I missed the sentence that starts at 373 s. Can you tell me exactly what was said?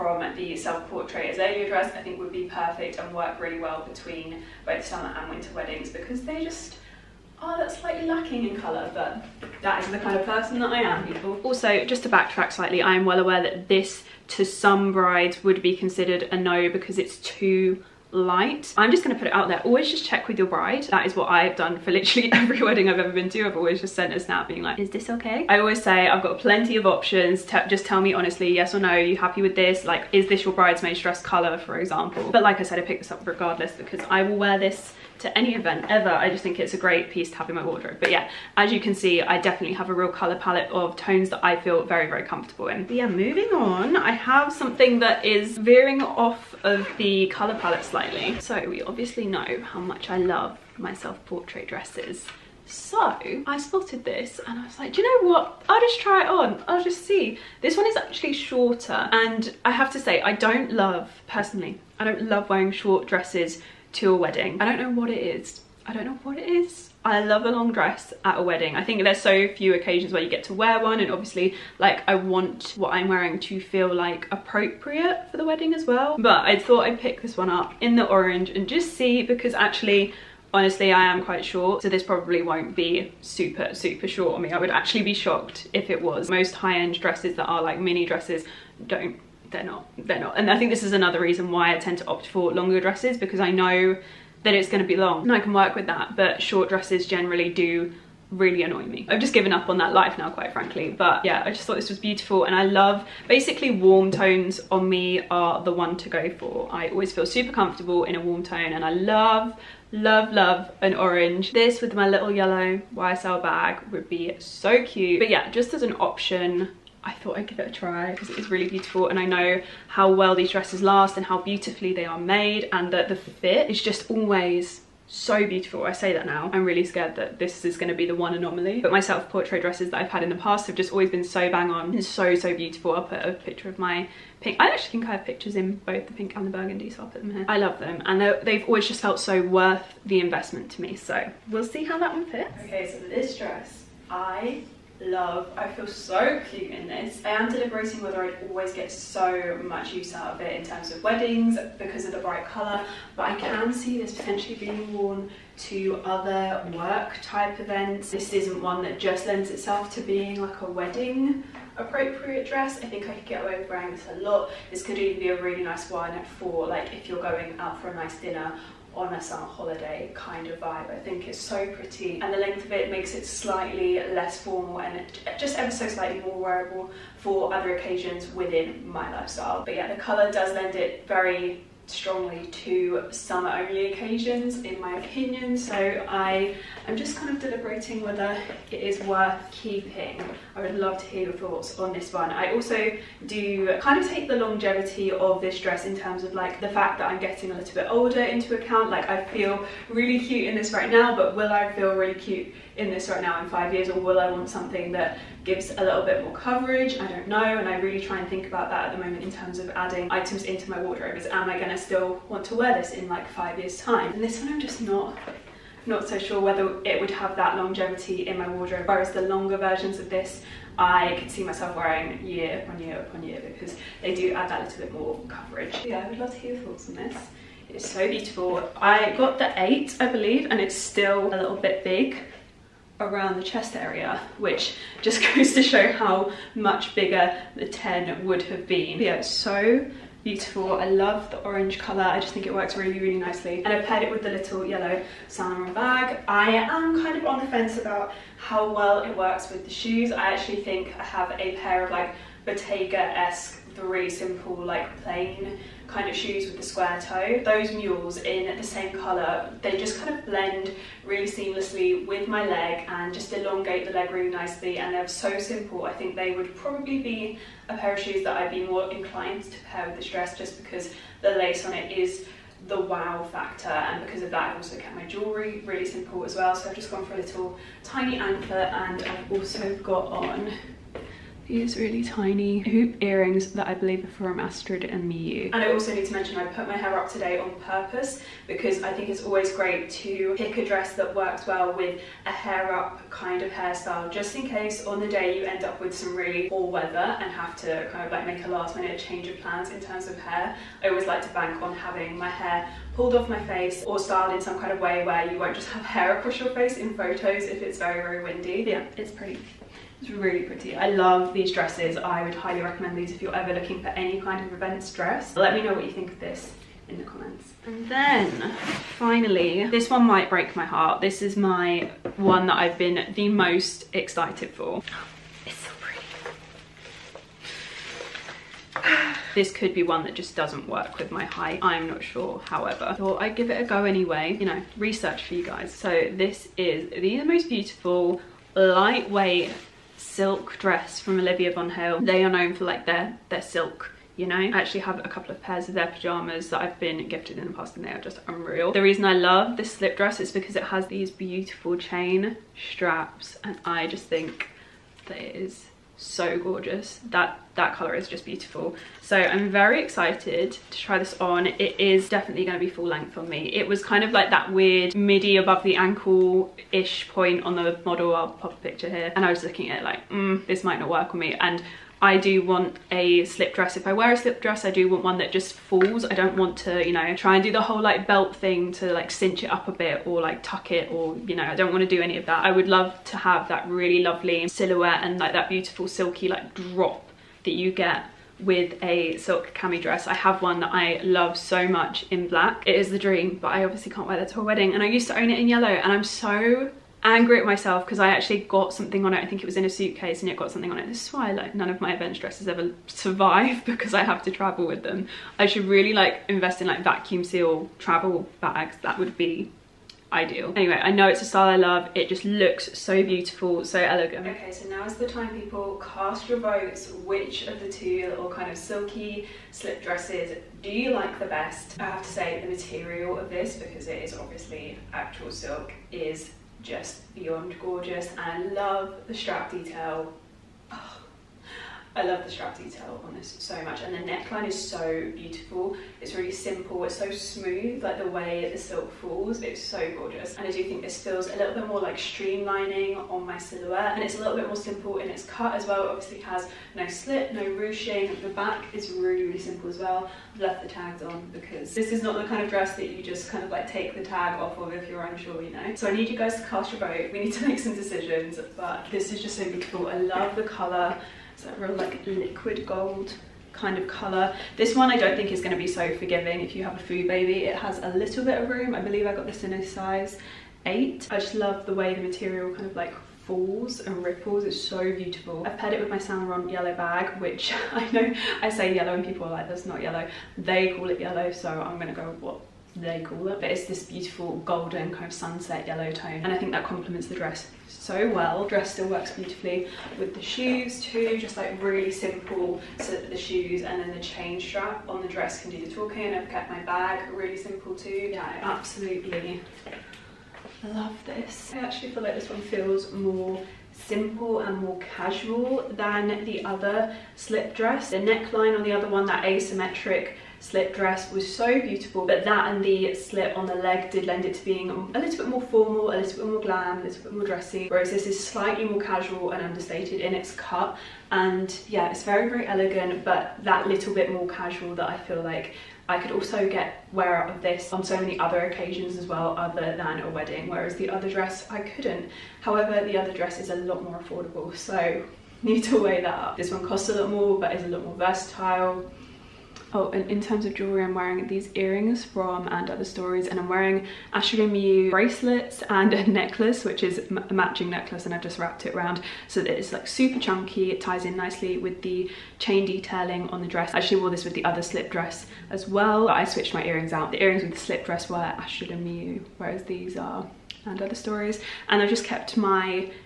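If I wear a slip dress, I do want one that just falls.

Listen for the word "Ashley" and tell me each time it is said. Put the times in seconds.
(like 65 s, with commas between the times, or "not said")
544 s, 558 s.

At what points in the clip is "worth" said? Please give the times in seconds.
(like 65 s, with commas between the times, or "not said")
139 s, 189 s.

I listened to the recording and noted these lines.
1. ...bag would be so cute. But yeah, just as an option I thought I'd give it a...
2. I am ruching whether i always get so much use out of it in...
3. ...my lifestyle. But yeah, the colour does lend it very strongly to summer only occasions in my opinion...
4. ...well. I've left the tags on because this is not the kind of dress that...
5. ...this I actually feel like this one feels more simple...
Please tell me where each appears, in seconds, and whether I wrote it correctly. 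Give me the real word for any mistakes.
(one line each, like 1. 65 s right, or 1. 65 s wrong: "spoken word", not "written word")
1. 113 s right
2. 147 s wrong: "deliberating", not "ruching"
3. 178 s right
4. 449 s right
5. 501 s right.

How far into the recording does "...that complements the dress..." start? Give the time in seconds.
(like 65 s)
486 s.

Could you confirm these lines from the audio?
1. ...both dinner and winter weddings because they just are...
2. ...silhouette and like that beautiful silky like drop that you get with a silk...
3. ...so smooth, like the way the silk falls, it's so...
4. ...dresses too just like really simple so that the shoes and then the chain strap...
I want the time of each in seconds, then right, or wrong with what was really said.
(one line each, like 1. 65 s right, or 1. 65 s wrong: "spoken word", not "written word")
1. 4 s wrong: "summer", not "dinner"
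2. 384 s right
3. 436 s right
4. 490 s wrong: "shoes", not "dresses".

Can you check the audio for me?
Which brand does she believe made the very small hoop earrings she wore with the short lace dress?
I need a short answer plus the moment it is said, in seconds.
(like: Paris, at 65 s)
Astrid and Miyu, at 284 s.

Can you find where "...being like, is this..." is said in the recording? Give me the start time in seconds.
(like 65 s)
24 s.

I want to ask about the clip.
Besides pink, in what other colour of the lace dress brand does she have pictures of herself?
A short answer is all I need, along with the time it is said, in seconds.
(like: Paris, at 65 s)
Burgundy, at 136 s.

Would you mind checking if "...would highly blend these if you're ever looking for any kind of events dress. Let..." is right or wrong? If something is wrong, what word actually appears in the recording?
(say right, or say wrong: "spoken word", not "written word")
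wrong: "recommend", not "blend".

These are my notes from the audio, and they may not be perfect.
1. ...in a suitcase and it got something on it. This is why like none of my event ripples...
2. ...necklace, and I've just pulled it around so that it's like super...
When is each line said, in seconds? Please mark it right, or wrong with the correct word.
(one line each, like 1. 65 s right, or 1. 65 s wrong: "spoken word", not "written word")
1. 399 s wrong: "dresses", not "ripples"
2. 547 s wrong: "wrapped", not "pulled".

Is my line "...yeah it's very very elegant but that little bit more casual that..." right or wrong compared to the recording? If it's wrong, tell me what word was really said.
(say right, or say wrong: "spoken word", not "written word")
right.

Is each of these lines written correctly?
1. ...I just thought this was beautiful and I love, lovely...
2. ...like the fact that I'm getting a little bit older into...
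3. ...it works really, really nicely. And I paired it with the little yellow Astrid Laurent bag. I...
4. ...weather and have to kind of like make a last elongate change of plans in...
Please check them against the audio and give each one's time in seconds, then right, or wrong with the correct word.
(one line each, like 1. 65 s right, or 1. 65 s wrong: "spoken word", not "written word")
1. 101 s wrong: "basically", not "lovely"
2. 196 s right
3. 242 s wrong: "Saint", not "Astrid"
4. 296 s wrong: "minute", not "elongate".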